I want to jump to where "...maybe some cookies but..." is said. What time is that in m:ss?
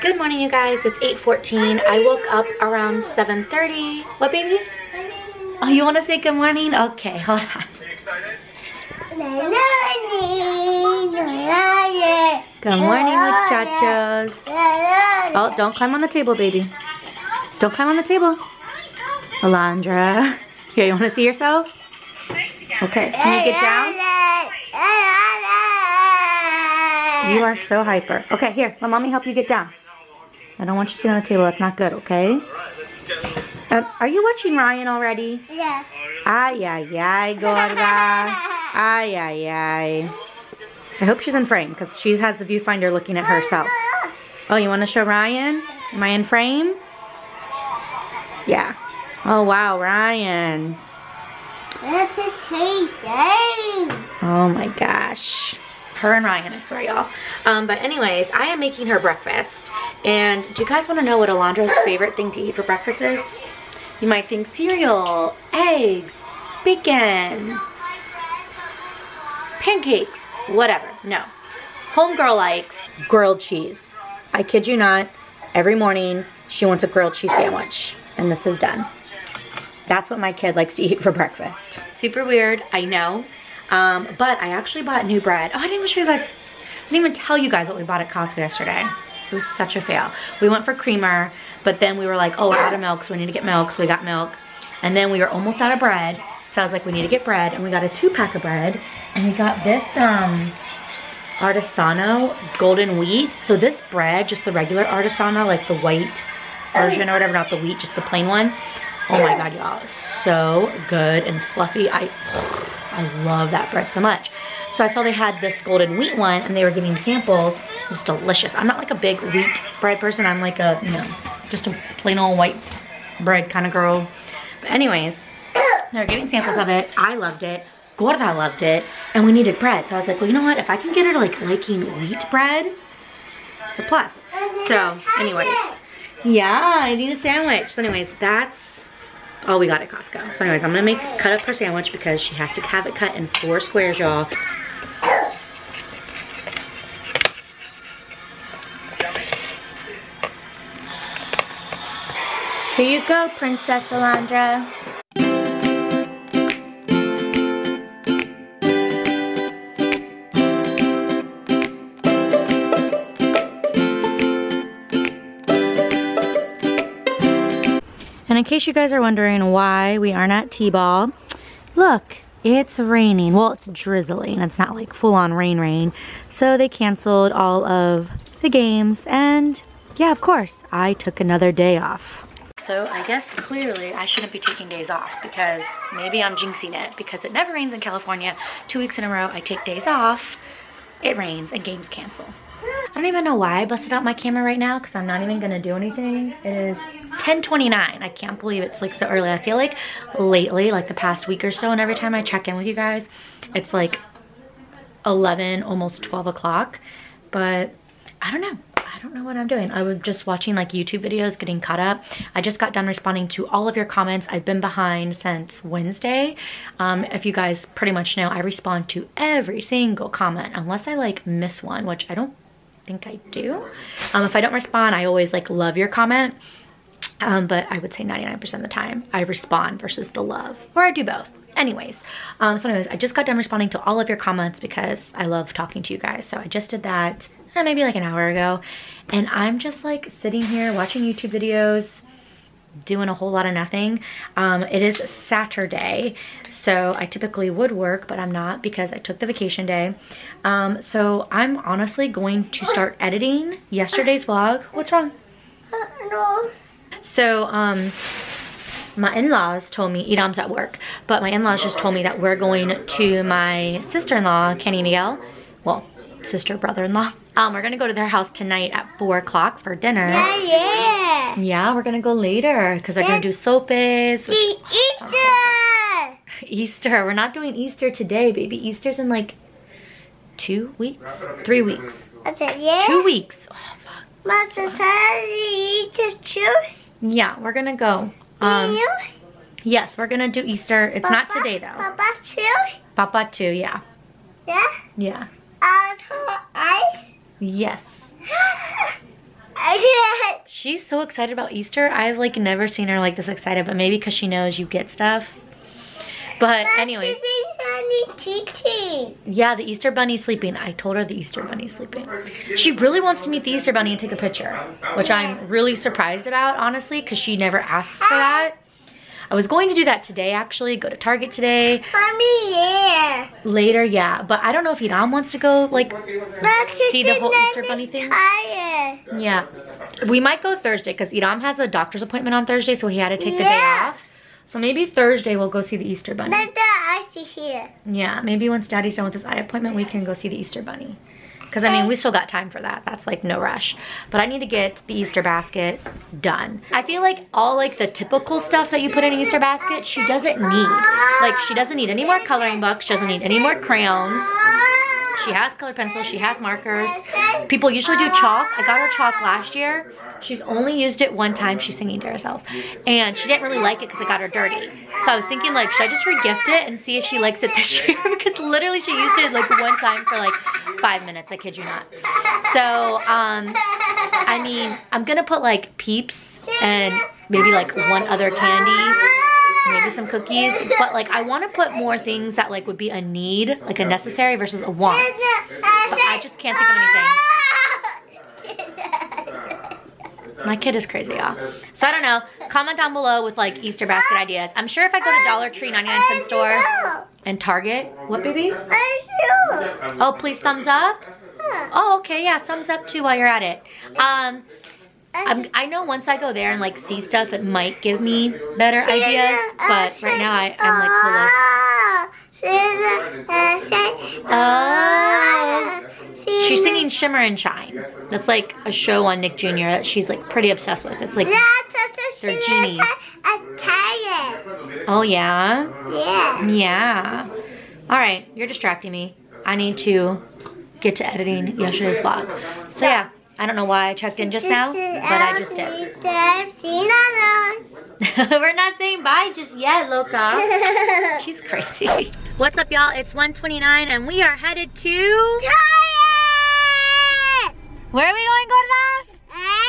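6:19.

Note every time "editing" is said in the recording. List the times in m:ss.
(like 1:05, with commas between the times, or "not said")
4:12, 7:11.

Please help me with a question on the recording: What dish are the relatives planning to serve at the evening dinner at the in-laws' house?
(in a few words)
Sopes.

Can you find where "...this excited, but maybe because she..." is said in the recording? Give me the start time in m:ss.
5:03.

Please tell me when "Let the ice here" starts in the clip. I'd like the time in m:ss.
5:36.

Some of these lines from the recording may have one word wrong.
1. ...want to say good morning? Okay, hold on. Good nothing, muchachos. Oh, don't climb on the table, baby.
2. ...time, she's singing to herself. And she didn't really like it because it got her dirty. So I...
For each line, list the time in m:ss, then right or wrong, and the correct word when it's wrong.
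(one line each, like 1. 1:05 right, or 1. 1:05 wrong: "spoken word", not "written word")
1. 0:05 wrong: "morning", not "nothing"
2. 6:01 right.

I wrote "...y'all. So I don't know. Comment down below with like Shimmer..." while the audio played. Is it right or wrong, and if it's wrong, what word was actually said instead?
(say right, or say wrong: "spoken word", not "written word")
wrong: "Easter", not "Shimmer".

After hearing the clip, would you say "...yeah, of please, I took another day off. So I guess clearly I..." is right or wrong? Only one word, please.
wrong.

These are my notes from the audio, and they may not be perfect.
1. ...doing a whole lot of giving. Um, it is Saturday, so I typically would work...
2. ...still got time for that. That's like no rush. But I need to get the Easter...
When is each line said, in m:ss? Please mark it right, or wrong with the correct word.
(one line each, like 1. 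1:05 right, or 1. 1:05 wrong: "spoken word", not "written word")
1. 4:02 wrong: "nothing", not "giving"
2. 5:41 right.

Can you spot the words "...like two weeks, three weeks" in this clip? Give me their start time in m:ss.
4:39.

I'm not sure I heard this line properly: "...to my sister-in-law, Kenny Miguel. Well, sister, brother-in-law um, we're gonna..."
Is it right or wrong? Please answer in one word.
right.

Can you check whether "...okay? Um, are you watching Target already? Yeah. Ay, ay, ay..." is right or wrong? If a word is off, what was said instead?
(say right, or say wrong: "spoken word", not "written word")
wrong: "Ryan", not "Target".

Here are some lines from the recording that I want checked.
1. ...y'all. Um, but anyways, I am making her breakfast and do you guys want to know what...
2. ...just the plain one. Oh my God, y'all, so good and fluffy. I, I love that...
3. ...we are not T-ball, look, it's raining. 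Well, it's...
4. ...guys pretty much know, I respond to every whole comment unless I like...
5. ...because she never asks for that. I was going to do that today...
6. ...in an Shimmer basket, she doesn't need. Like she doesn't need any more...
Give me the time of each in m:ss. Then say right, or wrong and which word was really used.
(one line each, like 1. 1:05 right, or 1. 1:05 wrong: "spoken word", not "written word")
1. 0:56 right
2. 1:47 right
3. 2:49 right
4. 3:37 wrong: "single", not "whole"
5. 5:17 right
6. 5:49 wrong: "Easter", not "Shimmer".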